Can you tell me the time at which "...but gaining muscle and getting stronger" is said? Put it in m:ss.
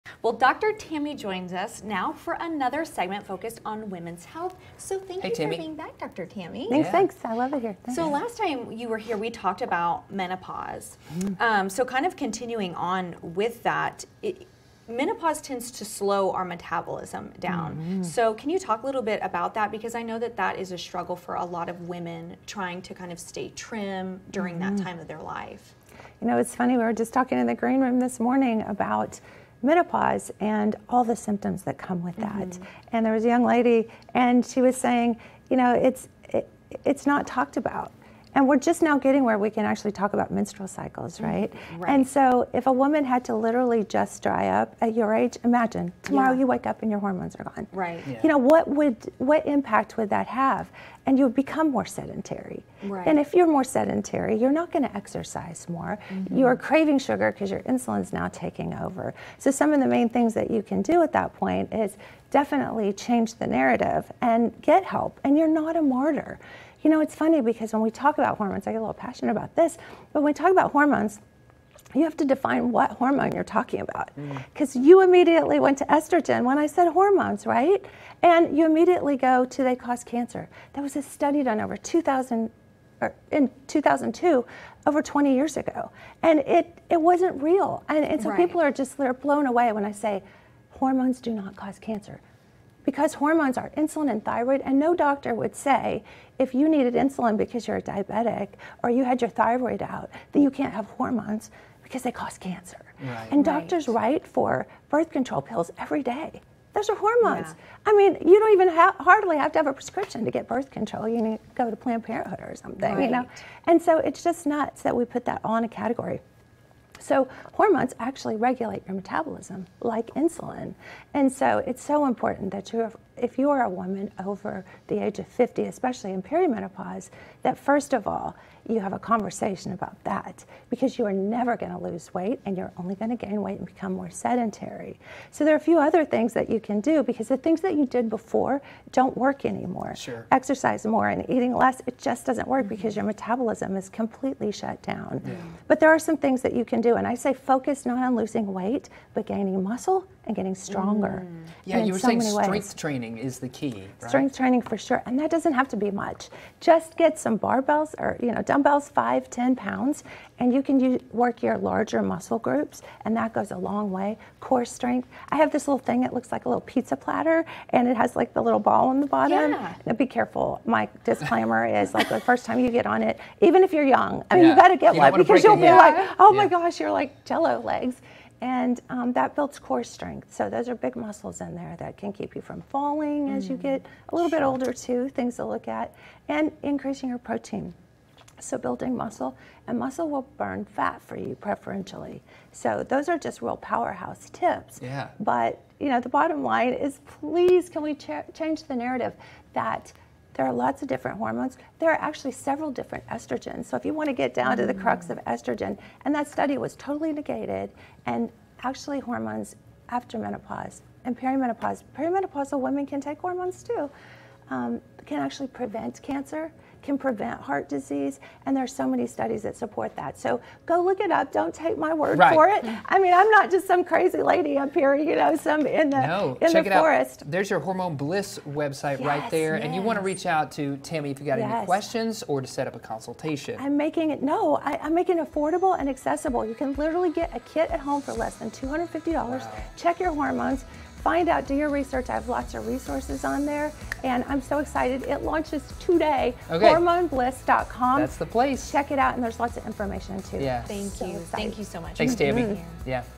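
2:29.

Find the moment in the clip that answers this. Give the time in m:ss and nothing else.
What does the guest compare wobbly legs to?
2:57.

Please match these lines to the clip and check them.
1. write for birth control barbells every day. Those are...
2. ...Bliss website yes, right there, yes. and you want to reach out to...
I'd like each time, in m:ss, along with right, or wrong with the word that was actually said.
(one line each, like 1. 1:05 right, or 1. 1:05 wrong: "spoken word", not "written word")
1. 1:44 wrong: "pills", not "barbells"
2. 3:47 right.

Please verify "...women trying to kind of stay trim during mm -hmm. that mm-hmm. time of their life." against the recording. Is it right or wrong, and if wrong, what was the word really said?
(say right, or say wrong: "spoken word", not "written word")
right.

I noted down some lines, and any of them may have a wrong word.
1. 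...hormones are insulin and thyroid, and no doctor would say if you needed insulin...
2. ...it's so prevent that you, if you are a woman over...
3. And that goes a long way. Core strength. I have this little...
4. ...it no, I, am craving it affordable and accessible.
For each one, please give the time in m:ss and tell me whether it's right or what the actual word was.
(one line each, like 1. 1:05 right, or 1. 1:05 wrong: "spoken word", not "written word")
1. 1:33 right
2. 2:01 wrong: "important", not "prevent"
3. 2:43 right
4. 3:54 wrong: "making", not "craving".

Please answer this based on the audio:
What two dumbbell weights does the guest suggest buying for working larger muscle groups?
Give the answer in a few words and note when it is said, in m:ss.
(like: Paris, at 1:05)
5, 10 pounds, at 2:38.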